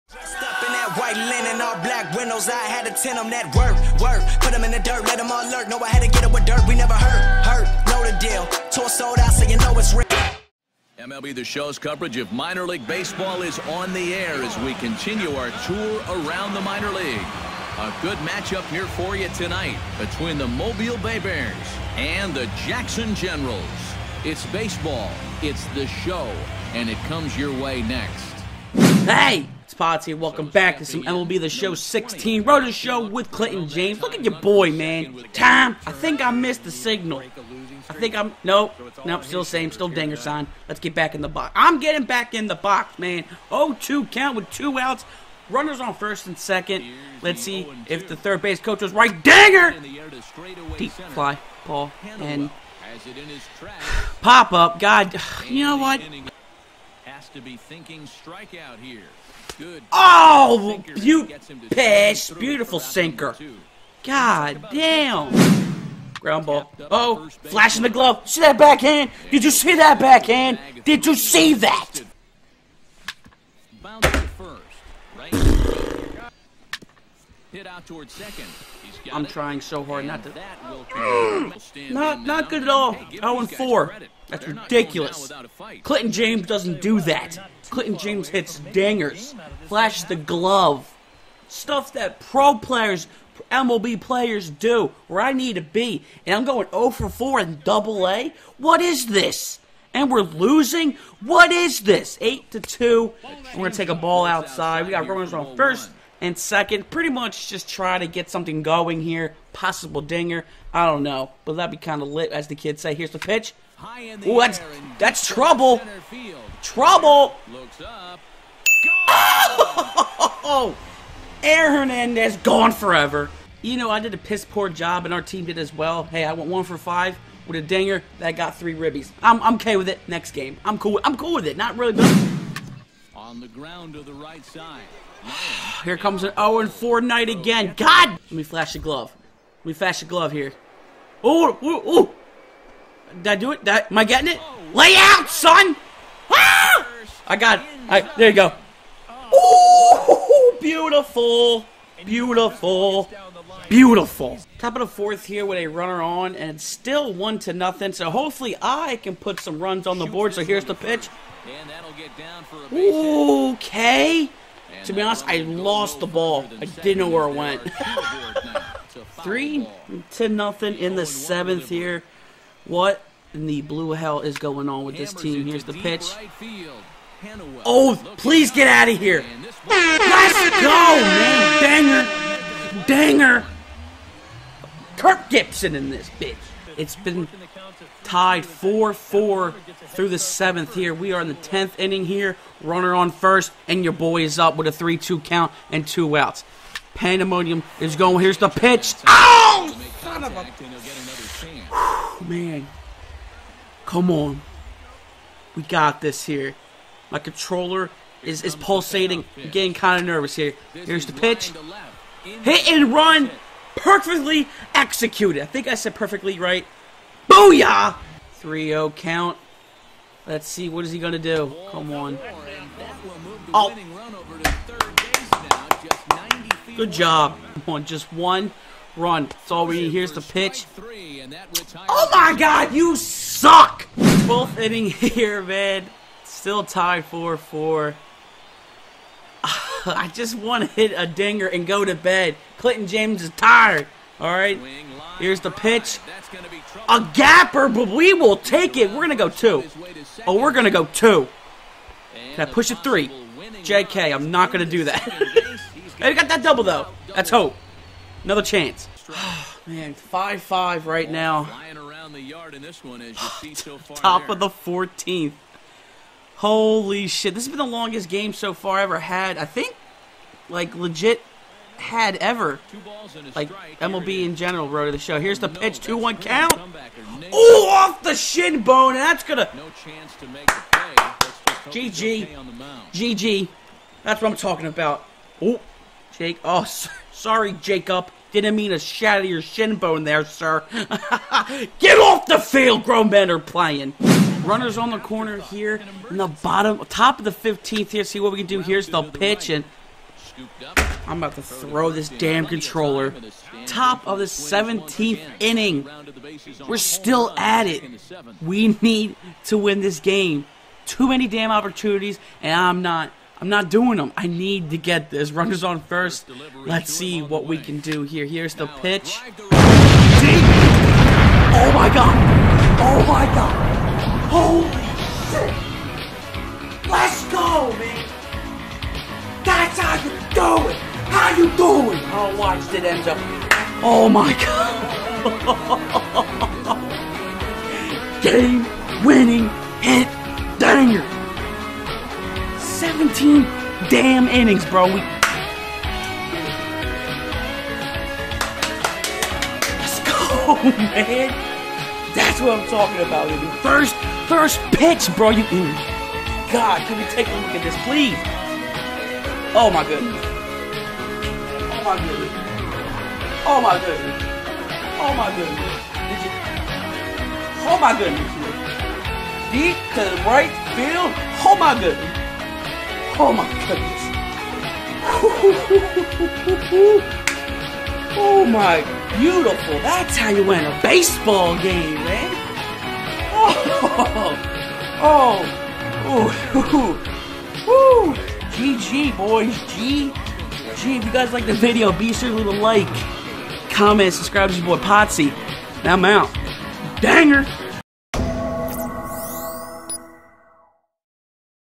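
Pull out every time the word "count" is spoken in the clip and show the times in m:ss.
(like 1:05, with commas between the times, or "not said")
0:44, 3:15, 3:38, 4:36.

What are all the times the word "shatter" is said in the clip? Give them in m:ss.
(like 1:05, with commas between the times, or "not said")
4:48.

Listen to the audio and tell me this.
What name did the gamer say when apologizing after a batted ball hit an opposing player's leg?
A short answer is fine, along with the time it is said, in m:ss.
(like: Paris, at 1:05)
Jacob, at 4:47.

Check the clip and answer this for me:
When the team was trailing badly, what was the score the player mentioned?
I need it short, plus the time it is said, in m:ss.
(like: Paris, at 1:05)
8 to 2, at 1:42.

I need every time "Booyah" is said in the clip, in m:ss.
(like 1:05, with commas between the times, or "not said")
3:37.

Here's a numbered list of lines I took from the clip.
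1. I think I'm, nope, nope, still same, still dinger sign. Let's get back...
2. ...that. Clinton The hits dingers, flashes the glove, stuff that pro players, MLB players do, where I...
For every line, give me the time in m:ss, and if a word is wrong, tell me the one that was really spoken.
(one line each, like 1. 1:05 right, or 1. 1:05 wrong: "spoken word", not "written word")
1. 0:37 right
2. 1:27 wrong: "James", not "The".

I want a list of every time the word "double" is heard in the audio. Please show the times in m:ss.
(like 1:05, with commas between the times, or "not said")
1:37, 4:16.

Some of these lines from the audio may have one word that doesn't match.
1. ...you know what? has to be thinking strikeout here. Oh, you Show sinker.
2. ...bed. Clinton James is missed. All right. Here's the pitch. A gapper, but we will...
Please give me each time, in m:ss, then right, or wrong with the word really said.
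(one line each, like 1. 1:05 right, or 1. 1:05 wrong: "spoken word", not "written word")
1. 0:55 wrong: "Beautiful", not "Show"
2. 4:01 wrong: "tired", not "missed".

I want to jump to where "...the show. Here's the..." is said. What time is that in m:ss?
4:34.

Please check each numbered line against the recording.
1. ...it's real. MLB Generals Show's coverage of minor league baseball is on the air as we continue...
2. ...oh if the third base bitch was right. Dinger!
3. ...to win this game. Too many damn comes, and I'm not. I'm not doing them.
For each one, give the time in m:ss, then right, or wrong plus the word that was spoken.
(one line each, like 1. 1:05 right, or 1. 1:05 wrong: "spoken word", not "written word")
1. 0:09 wrong: "The", not "Generals"
2. 0:47 wrong: "coach", not "bitch"
3. 5:09 wrong: "opportunities", not "comes".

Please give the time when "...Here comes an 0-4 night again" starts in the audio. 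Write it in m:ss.
2:15.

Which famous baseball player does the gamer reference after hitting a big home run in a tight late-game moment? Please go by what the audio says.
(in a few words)
Kirk Gibson.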